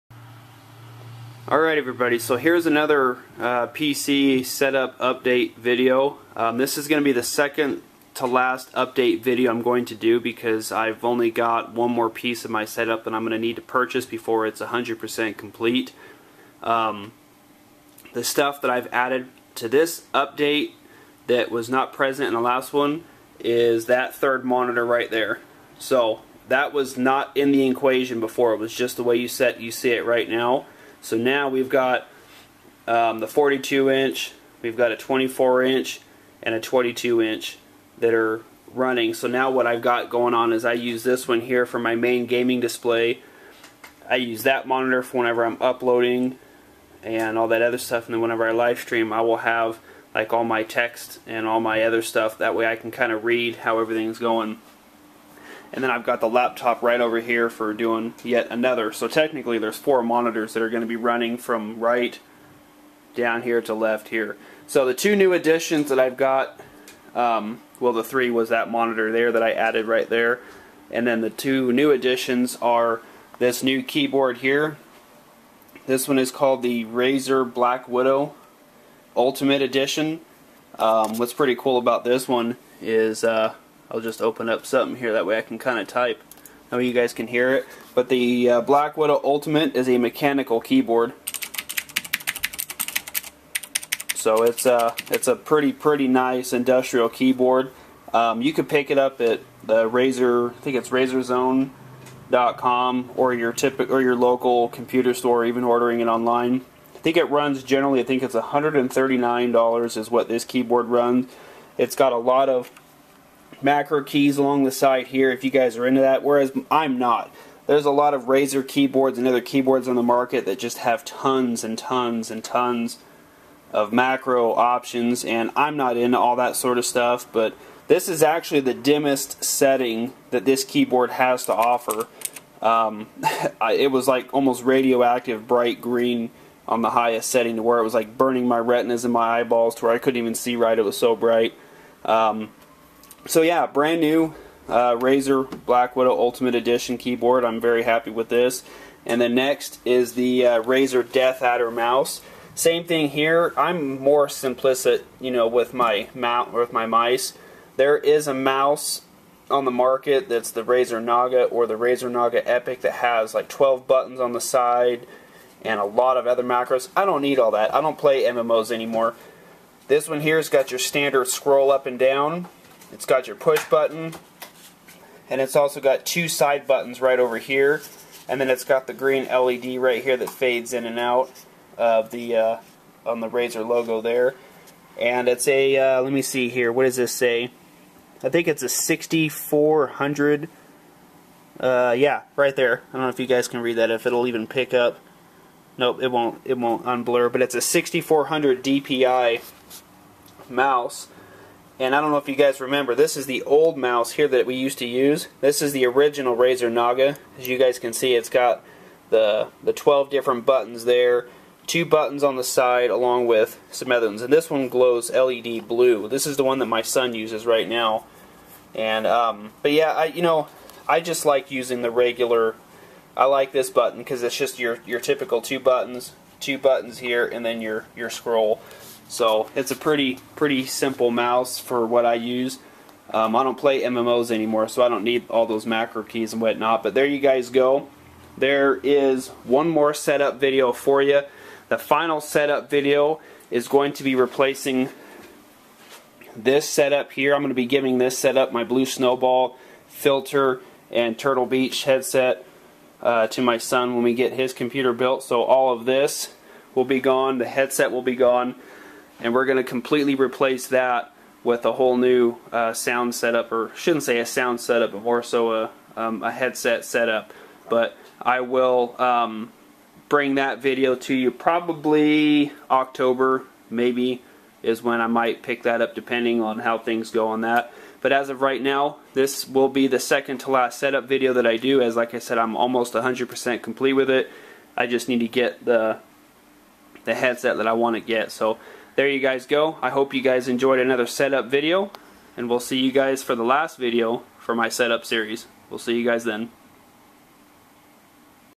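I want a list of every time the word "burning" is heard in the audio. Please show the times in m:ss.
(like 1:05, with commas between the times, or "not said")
2:18.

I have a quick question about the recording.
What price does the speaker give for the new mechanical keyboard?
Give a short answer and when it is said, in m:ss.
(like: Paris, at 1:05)
$139, at 1:48.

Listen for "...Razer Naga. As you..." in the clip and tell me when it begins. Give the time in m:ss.
3:26.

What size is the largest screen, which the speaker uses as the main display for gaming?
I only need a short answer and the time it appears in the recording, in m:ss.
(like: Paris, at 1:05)
42 inch, at 0:33.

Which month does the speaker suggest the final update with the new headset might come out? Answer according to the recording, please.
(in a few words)
October.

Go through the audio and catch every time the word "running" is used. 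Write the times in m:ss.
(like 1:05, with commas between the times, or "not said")
0:38, 1:00.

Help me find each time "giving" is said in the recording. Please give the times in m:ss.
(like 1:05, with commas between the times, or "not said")
4:07.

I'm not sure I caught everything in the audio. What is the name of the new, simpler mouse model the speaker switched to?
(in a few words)
Razer Death Adder.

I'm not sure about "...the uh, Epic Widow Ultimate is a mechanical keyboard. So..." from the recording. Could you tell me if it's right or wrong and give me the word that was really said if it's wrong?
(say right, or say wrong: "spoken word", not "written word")
wrong: "Black", not "Epic".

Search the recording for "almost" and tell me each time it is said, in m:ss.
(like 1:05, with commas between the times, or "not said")
2:14, 4:42.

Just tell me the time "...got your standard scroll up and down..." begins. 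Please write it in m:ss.
2:50.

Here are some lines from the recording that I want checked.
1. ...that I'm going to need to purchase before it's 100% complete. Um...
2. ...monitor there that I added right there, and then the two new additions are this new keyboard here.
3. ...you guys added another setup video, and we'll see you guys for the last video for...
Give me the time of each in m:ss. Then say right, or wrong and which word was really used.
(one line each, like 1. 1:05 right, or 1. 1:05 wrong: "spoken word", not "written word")
1. 0:13 right
2. 1:08 right
3. 4:50 wrong: "enjoyed", not "added".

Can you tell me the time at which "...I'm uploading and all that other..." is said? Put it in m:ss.
0:45.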